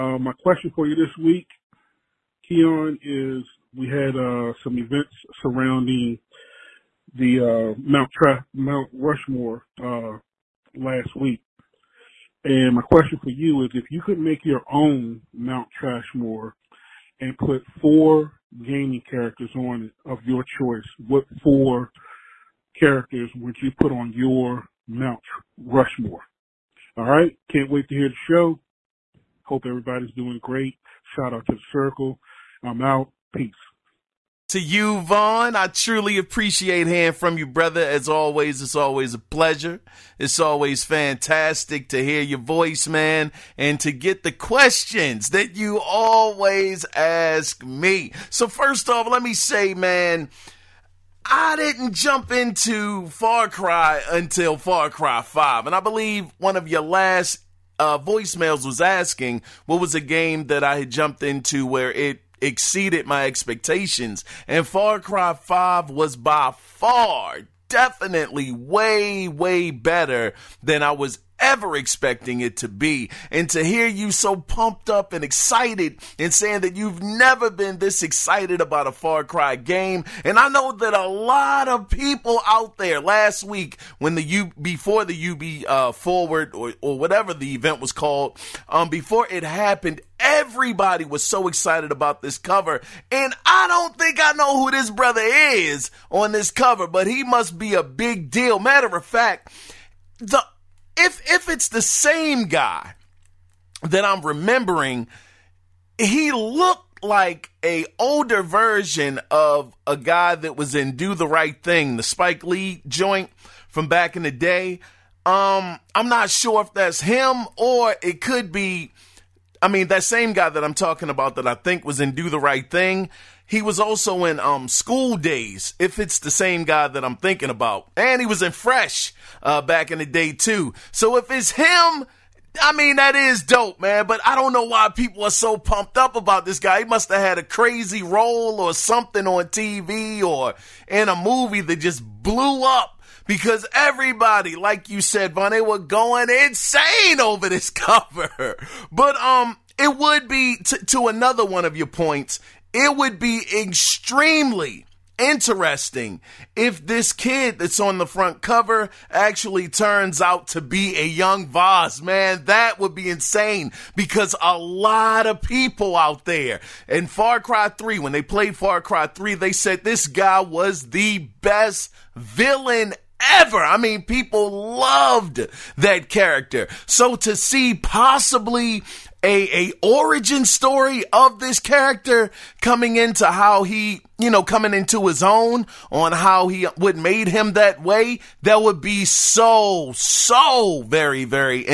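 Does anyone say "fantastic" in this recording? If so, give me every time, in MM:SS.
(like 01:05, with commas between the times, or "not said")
00:40.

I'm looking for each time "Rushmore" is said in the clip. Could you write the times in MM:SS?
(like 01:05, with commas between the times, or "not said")
00:08, 00:25.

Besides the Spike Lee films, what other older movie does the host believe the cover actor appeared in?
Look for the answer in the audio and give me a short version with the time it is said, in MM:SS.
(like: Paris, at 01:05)
Fresh, at 02:08.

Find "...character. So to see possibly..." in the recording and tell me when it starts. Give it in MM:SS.
02:56.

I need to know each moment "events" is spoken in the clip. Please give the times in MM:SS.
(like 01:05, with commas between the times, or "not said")
00:04, 01:27.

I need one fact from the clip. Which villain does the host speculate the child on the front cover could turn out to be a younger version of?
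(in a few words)
Voss.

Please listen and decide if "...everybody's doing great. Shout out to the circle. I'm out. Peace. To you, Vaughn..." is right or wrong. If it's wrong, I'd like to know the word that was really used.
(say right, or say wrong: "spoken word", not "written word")
right.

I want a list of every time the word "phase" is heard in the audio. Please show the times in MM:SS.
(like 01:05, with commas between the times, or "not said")
not said.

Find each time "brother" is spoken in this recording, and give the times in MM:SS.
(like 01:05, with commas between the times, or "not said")
00:37, 01:34.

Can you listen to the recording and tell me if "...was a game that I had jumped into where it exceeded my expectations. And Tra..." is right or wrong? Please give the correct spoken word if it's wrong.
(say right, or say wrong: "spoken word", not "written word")
wrong: "Far", not "Tra".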